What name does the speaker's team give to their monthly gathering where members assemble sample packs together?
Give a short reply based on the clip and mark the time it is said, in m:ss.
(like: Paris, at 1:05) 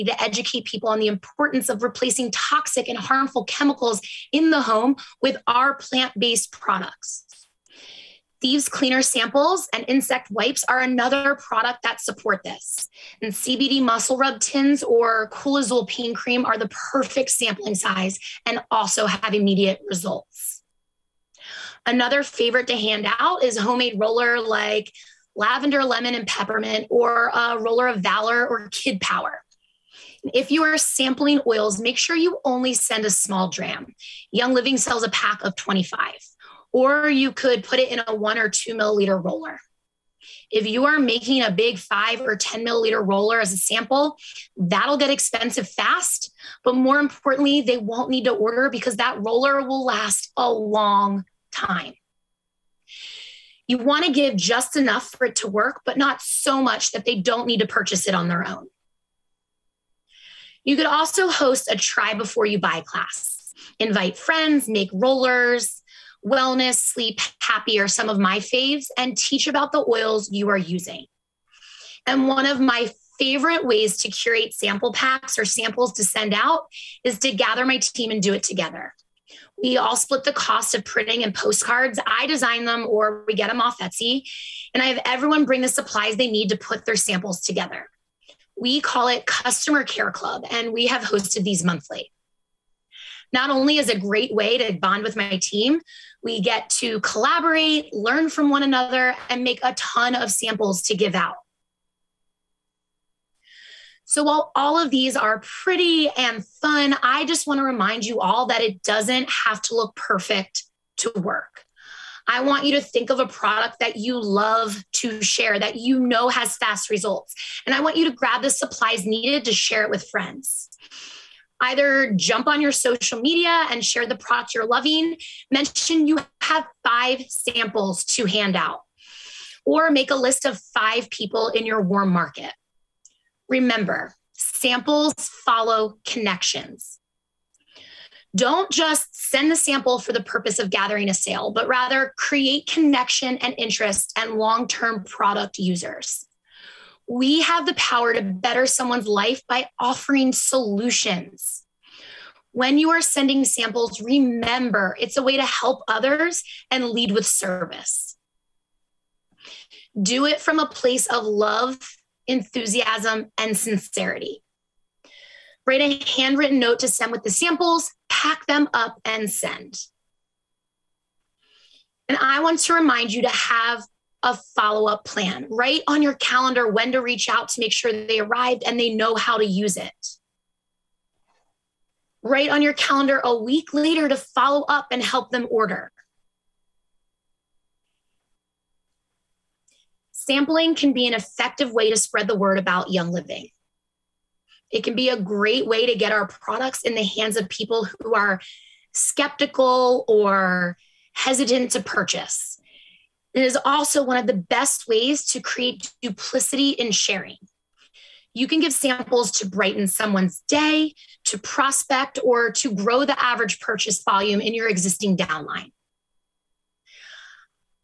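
Customer Care Club, at 1:29.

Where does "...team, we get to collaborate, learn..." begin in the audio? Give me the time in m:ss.
1:35.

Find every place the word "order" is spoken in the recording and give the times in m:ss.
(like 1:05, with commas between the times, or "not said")
0:48, 3:05.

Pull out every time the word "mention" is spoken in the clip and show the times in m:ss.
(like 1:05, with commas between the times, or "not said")
2:05.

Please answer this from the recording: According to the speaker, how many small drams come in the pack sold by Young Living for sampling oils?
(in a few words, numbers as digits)
25.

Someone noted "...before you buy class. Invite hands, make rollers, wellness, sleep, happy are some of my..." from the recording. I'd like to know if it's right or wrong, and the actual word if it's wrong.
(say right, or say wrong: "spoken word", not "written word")
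wrong: "friends", not "hands".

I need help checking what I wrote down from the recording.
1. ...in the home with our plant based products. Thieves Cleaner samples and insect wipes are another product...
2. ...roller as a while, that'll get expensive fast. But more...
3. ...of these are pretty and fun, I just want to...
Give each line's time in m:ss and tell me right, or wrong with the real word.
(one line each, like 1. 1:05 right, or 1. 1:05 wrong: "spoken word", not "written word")
1. 0:04 right
2. 0:43 wrong: "sample", not "while"
3. 1:44 right.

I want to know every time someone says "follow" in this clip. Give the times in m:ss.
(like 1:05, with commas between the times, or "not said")
2:15, 2:54, 3:04.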